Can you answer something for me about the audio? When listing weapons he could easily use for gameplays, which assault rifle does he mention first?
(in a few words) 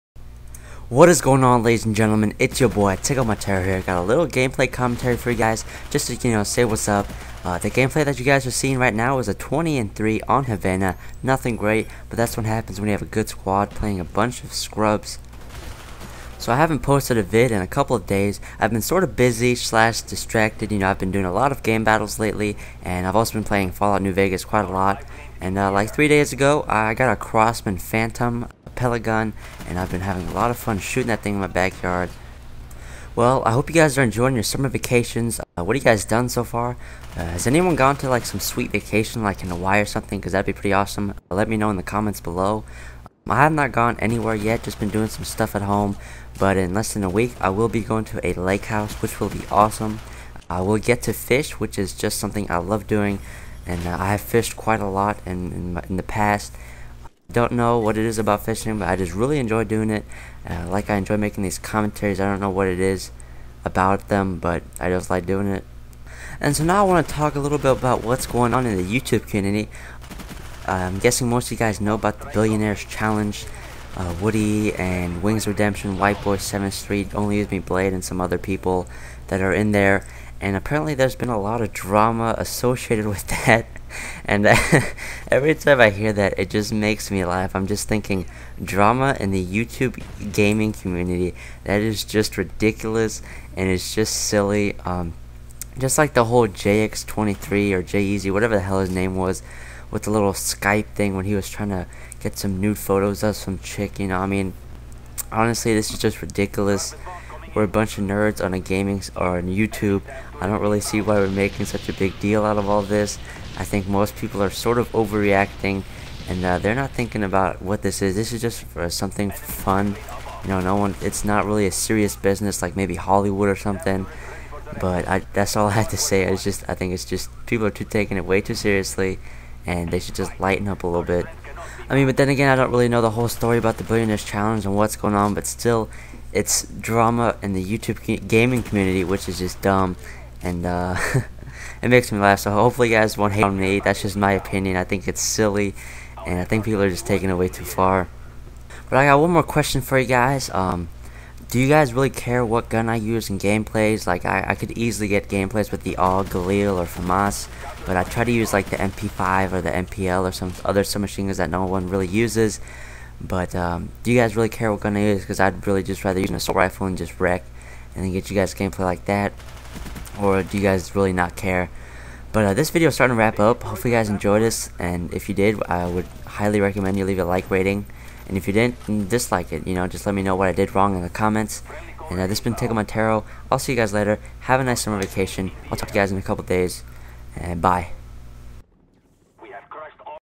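AUG.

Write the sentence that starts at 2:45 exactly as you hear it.
Because I'd really just rather use an assault rifle and just wreck and get you guys gameplay like that.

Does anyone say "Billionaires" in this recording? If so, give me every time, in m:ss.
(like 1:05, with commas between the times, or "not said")
1:12, 2:13.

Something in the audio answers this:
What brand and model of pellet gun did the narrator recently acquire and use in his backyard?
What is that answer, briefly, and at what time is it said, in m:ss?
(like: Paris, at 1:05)
Crosman Phantom, at 0:27.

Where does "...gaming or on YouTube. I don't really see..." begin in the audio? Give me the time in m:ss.
1:48.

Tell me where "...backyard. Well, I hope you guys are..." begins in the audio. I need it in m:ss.
0:31.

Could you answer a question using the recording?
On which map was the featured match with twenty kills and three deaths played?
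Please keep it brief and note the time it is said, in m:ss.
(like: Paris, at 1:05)
Havana, at 0:10.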